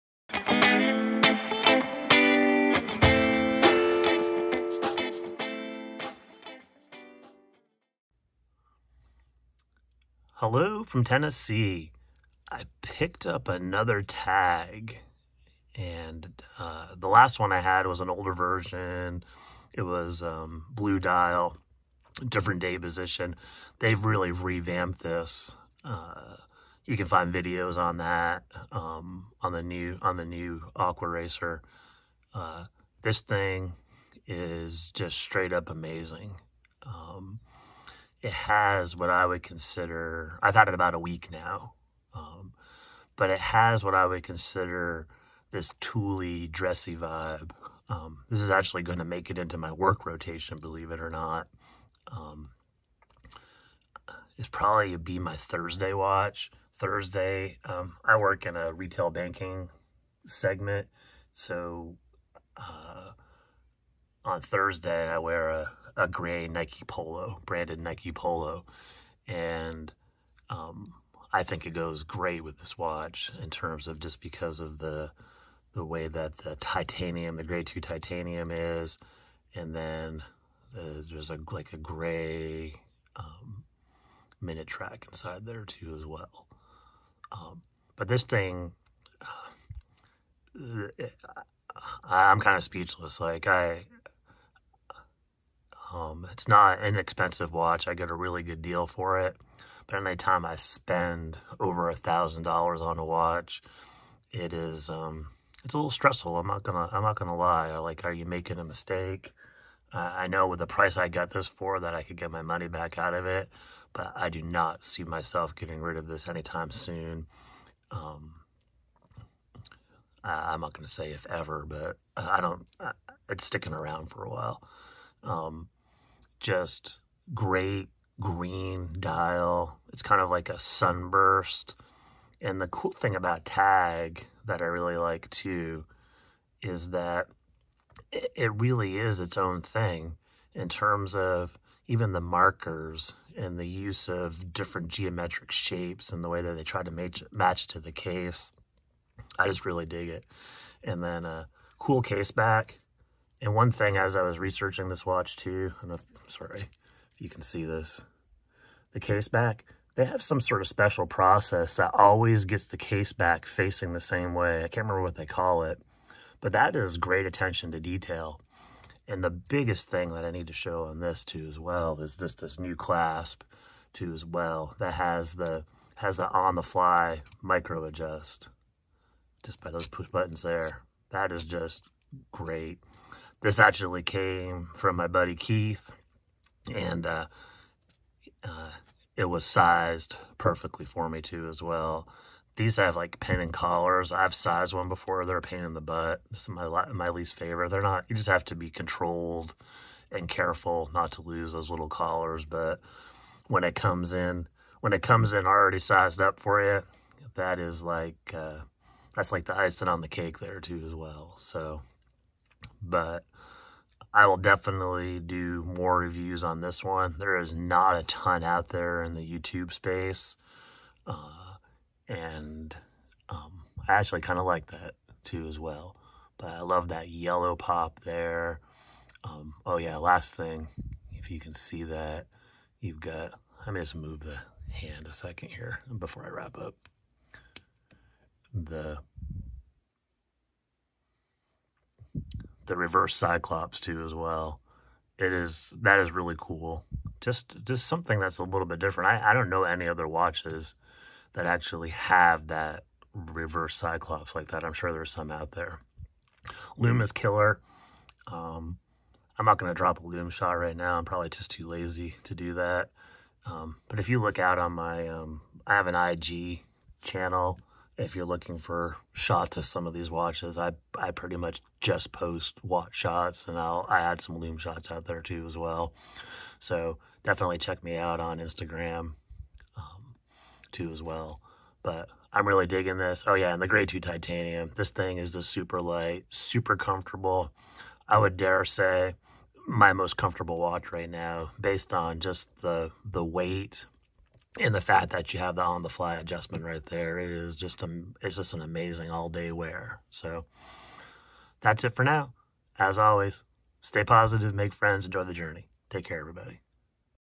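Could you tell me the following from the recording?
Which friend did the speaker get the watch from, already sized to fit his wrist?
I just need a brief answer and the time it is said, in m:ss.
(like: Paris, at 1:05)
Keith, at 3:05.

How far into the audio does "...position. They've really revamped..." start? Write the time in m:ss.
0:22.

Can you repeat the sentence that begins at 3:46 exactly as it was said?
But I love that yellow pop there.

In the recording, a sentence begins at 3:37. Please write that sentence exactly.
There is not a ton out there in the YouTube space.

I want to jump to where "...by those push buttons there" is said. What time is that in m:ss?
2:59.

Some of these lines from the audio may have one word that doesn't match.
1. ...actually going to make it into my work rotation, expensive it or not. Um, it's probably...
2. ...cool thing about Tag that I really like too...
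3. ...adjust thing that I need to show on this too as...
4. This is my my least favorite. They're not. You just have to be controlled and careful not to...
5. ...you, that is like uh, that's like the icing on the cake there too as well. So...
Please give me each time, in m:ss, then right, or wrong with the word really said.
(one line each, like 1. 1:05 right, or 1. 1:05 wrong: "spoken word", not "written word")
1. 0:48 wrong: "believe", not "expensive"
2. 2:12 right
3. 2:49 wrong: "biggest", not "adjust"
4. 3:16 right
5. 3:26 right.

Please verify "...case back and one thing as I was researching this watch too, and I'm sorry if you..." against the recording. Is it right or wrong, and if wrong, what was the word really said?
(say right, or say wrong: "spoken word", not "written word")
right.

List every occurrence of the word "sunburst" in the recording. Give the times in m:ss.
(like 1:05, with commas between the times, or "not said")
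2:10.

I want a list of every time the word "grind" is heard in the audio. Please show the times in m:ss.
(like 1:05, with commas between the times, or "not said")
not said.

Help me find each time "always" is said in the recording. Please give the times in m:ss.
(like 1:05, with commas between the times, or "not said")
2:41, 5:02.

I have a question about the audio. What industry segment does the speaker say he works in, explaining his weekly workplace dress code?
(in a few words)
retail banking.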